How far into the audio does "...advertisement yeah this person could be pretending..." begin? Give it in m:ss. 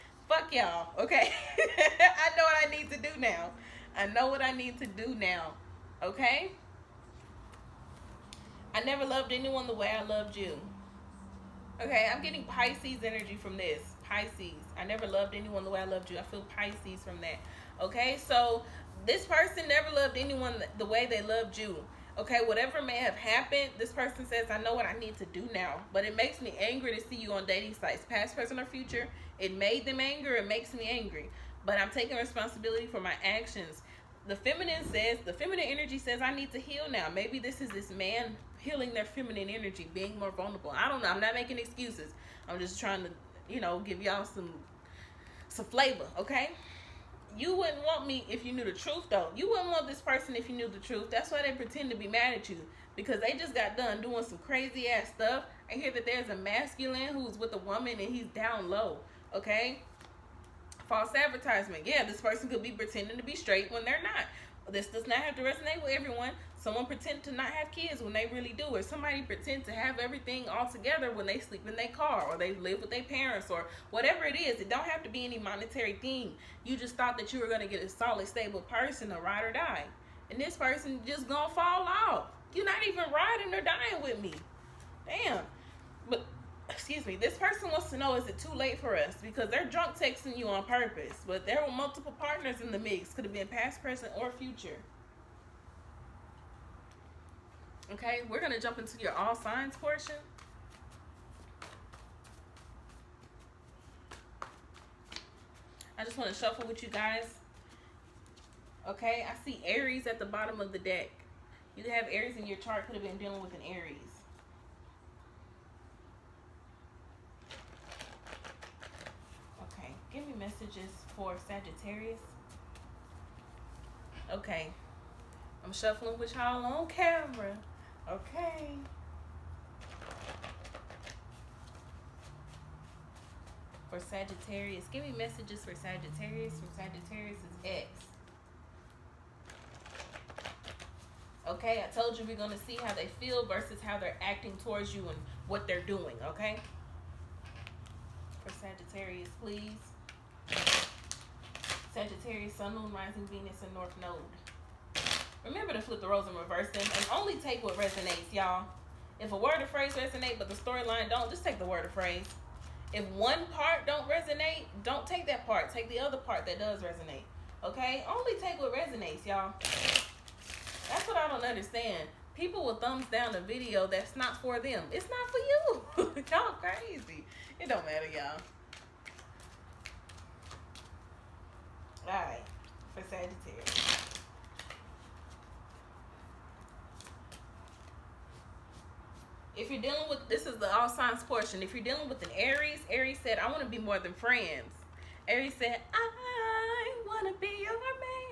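1:01.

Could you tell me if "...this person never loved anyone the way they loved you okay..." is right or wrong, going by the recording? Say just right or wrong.
right.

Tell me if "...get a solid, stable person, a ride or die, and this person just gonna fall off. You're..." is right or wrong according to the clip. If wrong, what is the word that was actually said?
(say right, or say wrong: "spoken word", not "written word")
right.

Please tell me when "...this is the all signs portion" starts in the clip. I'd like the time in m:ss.
3:10.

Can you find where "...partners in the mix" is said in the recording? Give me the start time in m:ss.
1:32.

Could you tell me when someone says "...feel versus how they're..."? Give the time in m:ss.
2:23.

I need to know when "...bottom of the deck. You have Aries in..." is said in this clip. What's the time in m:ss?
1:50.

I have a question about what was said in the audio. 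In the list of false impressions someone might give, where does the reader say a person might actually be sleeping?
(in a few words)
in their car.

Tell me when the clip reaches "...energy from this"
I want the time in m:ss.
0:13.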